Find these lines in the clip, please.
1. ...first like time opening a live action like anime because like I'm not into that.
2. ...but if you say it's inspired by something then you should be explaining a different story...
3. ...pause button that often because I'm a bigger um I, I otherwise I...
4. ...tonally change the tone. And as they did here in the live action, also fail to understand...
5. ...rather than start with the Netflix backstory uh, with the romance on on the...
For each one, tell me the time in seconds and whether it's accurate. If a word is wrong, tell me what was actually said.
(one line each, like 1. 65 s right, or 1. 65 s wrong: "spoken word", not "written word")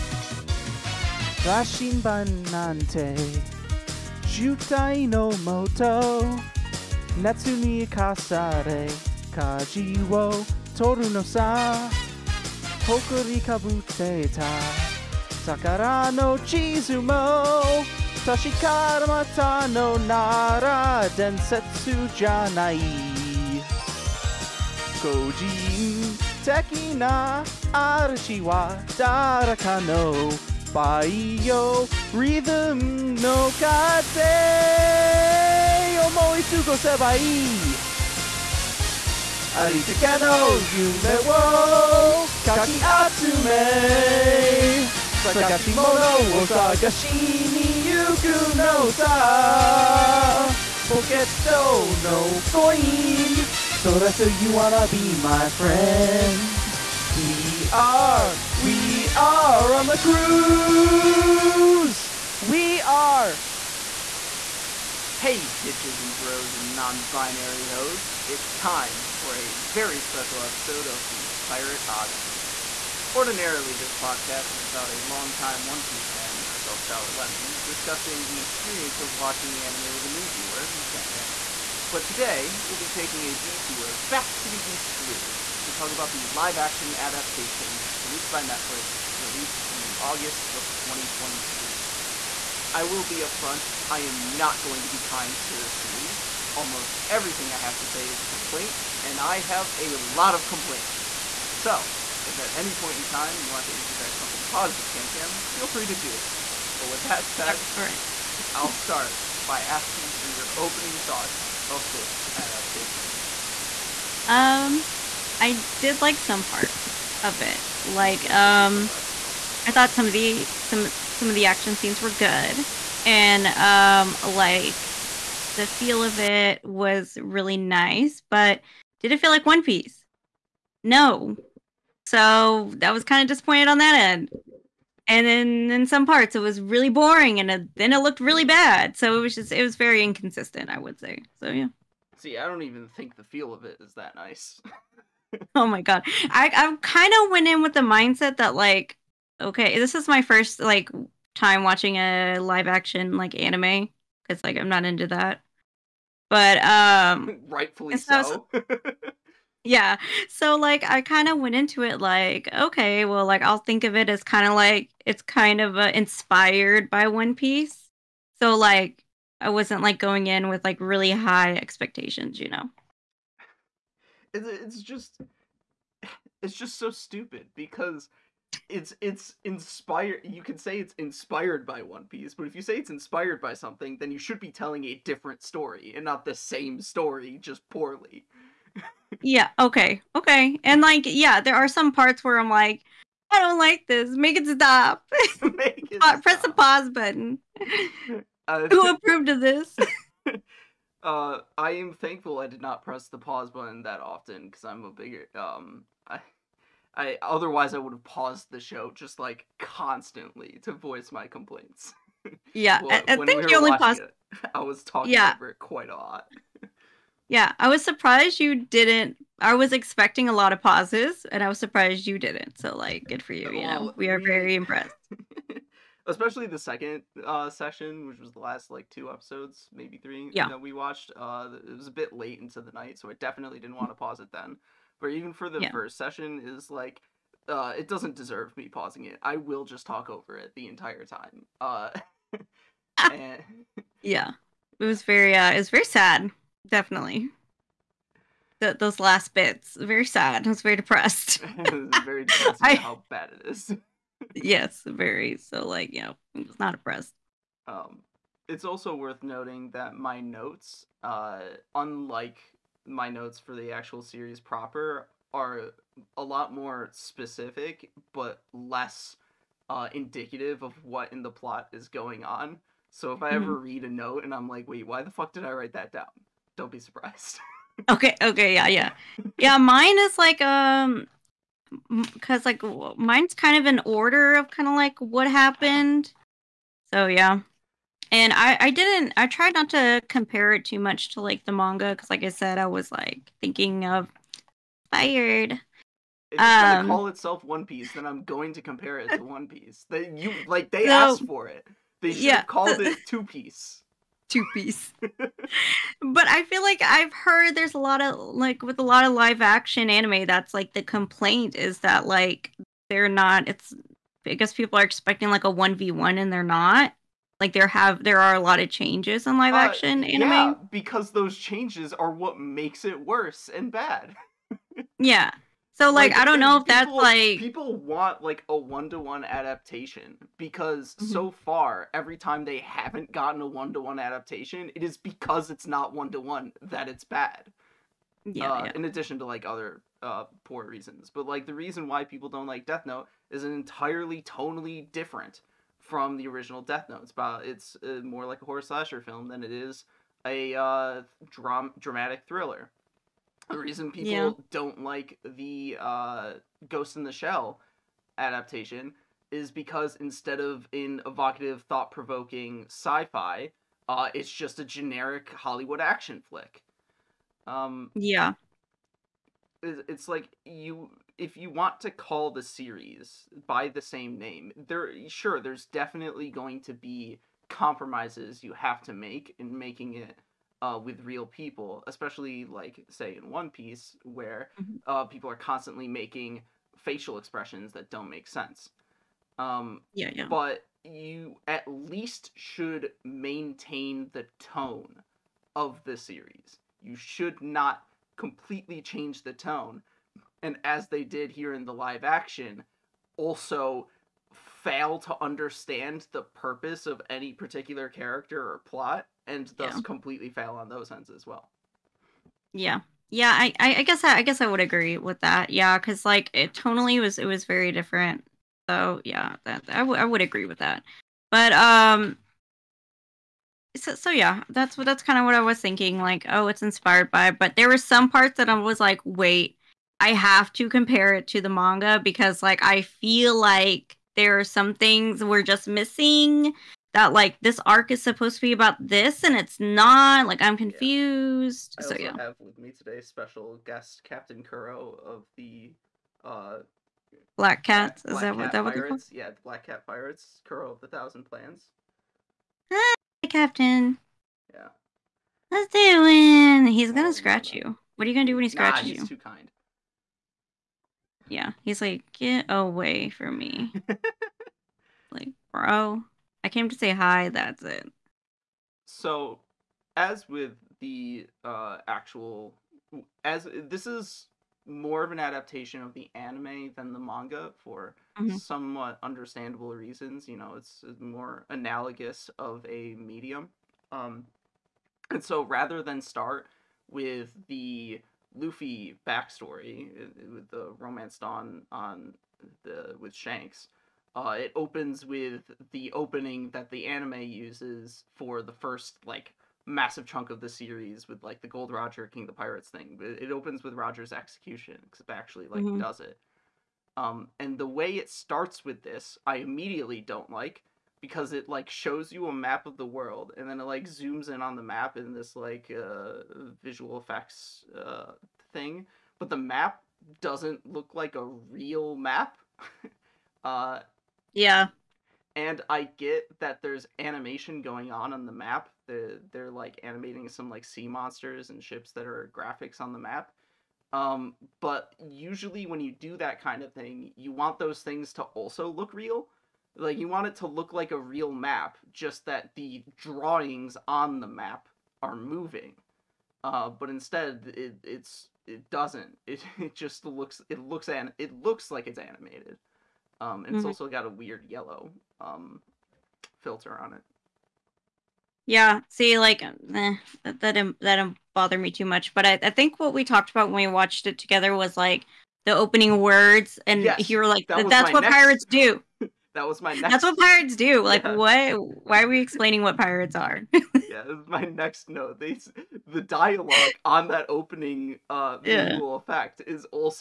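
1. 150 s wrong: "watching", not "opening"
2. 182 s wrong: "telling", not "explaining"
3. 203 s right
4. 398 s wrong: "completely", not "tonally"
5. 485 s wrong: "Luffy", not "Netflix".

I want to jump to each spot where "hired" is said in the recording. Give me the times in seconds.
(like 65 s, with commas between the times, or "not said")
not said.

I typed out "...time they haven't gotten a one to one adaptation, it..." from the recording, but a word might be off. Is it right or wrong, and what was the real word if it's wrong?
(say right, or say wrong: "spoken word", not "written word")
right.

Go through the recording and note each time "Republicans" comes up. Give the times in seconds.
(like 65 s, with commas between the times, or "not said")
not said.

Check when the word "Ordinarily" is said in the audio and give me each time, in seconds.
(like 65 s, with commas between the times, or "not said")
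73 s.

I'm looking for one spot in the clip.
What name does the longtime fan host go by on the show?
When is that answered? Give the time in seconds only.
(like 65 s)
76 s.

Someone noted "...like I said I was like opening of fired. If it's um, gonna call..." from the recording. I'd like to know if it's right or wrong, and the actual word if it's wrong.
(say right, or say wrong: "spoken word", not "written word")
wrong: "thinking", not "opening".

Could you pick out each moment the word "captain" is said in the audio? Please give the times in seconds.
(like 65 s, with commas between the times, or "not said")
444 s, 453 s.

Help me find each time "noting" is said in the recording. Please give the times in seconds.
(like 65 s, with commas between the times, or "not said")
259 s.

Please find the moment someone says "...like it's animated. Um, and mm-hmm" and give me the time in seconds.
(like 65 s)
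551 s.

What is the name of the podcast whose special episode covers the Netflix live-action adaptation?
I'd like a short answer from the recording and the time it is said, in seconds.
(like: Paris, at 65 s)
Pirate Odyssey, at 71 s.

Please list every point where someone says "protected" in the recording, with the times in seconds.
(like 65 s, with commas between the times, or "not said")
not said.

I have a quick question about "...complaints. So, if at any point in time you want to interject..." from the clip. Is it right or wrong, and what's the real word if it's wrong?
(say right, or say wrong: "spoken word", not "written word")
right.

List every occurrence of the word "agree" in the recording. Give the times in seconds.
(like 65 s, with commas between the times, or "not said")
414 s, 420 s.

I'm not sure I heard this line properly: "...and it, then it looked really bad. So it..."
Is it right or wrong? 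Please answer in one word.
right.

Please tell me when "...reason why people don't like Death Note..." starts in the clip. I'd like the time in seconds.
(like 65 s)
341 s.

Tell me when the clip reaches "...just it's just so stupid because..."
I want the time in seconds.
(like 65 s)
174 s.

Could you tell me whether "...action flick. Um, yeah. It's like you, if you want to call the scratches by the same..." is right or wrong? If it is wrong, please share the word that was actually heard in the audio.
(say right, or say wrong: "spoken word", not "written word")
wrong: "series", not "scratches".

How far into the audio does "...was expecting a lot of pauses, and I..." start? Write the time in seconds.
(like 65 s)
219 s.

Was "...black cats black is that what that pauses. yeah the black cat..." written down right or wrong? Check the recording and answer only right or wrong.
wrong.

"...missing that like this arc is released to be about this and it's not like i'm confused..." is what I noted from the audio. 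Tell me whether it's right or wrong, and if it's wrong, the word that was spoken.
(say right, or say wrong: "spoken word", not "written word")
wrong: "supposed", not "released".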